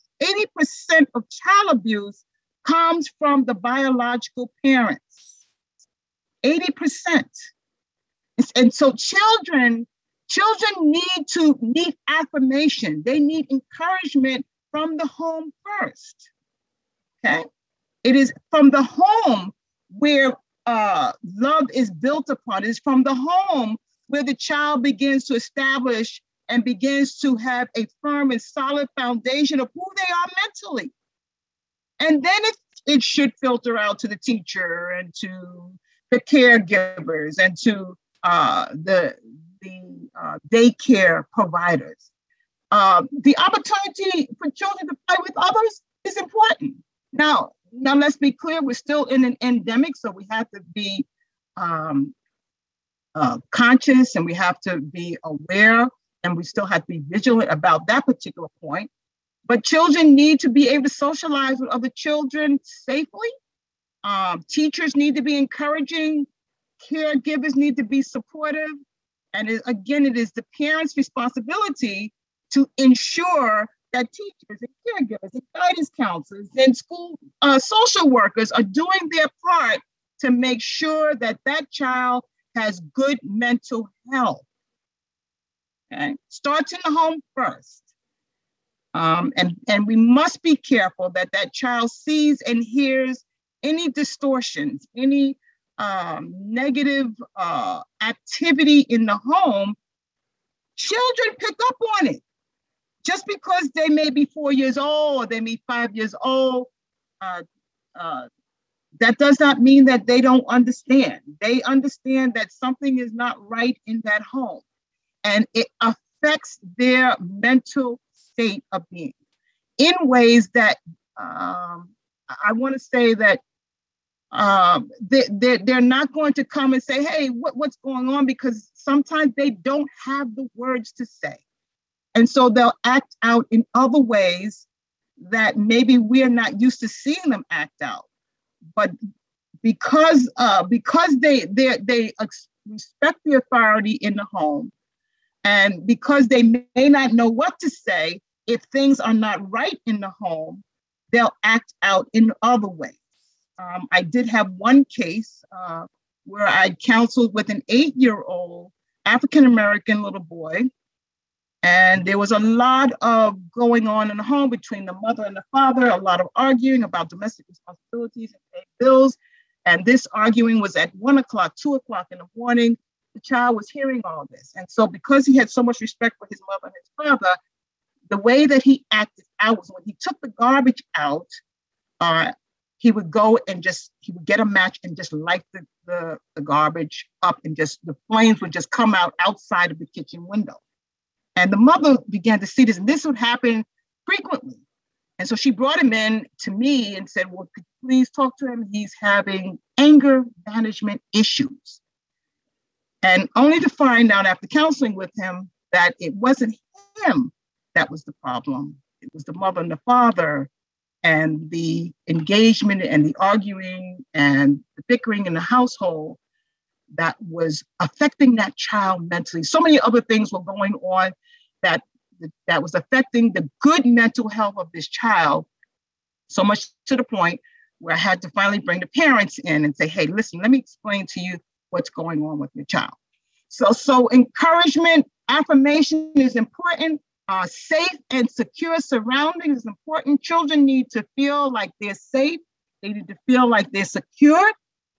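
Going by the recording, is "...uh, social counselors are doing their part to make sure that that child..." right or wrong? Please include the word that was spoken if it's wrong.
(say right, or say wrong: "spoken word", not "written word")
wrong: "workers", not "counselors".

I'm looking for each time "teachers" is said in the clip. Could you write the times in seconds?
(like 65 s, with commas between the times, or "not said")
34 s, 64 s, 74 s.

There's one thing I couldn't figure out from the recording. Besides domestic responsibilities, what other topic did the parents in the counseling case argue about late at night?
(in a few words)
paying bills.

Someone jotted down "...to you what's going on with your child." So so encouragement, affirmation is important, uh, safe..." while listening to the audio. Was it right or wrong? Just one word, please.
right.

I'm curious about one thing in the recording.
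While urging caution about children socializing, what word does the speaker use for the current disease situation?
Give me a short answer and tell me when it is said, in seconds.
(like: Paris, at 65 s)
endemic, at 49 s.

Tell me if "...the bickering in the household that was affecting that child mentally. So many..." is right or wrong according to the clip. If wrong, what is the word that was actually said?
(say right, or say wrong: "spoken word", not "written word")
right.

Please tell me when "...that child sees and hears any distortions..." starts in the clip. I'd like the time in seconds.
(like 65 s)
91 s.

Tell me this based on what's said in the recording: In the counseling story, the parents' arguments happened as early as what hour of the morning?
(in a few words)
1 o'clock.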